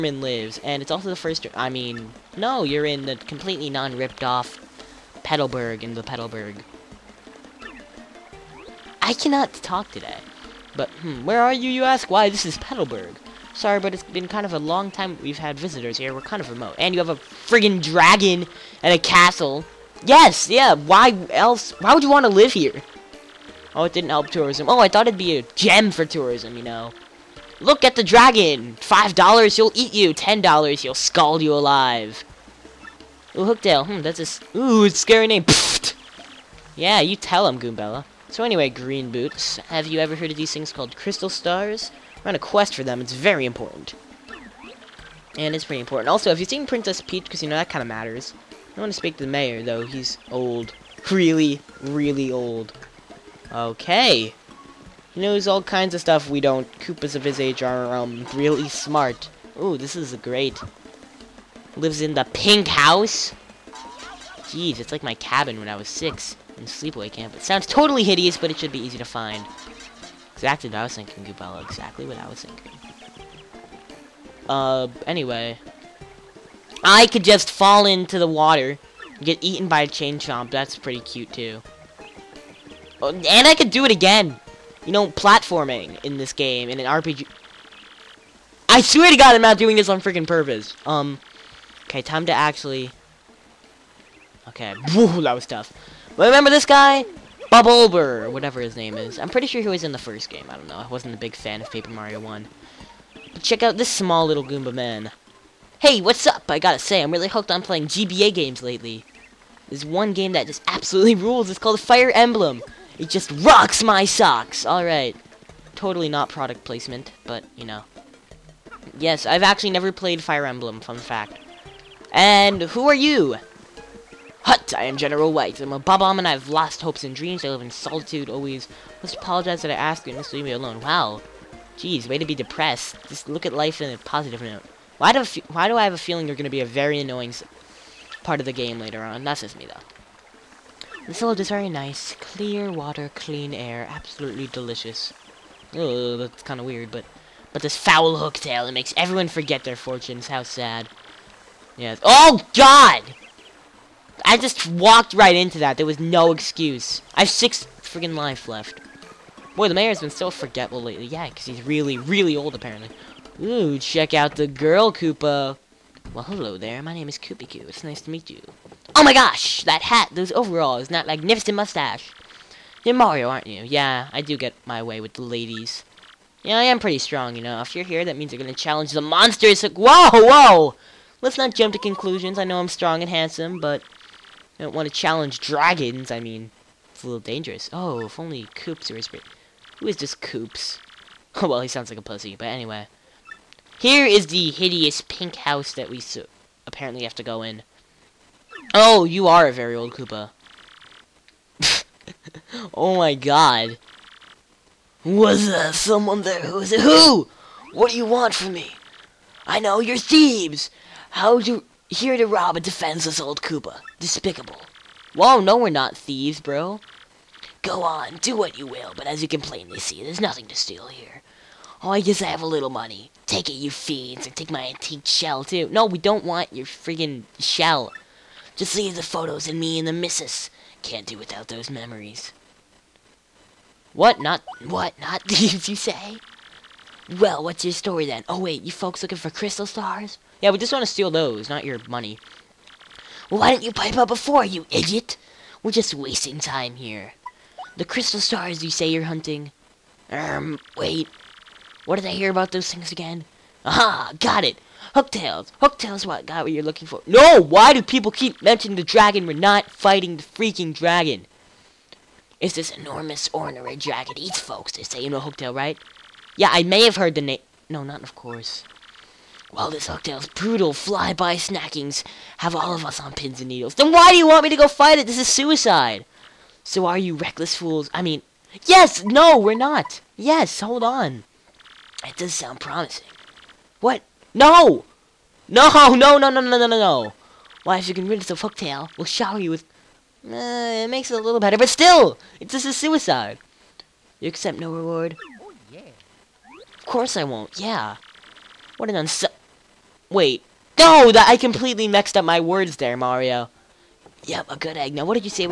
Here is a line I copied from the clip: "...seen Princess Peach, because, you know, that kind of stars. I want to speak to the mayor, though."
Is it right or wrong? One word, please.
wrong.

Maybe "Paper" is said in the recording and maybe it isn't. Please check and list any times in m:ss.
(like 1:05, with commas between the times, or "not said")
1:41.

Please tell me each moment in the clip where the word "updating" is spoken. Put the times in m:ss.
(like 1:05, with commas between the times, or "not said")
not said.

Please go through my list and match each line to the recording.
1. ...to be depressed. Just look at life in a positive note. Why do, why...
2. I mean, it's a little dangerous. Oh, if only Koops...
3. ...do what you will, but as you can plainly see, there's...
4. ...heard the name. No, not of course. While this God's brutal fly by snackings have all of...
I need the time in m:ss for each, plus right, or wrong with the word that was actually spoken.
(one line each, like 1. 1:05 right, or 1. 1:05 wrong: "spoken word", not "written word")
1. 2:12 right
2. 3:06 right
3. 3:38 right
4. 4:26 wrong: "Hooktail", not "God".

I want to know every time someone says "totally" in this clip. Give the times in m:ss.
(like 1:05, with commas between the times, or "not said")
1:07, 1:55.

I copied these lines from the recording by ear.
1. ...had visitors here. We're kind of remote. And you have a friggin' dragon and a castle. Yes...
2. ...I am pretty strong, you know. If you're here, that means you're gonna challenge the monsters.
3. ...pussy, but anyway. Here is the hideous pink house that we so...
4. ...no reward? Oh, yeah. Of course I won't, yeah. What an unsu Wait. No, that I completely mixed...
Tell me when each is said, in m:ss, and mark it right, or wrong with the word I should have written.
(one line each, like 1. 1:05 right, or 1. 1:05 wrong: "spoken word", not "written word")
1. 0:15 right
2. 2:56 right
3. 3:12 right
4. 4:54 right.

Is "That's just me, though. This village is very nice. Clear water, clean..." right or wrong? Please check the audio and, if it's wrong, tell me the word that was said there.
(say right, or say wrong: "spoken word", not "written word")
right.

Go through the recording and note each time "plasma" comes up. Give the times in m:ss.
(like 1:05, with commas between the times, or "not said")
not said.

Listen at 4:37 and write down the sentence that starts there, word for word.
I mean, yes, no, we're not.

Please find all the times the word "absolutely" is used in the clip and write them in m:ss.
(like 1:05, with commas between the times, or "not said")
1:50, 2:23.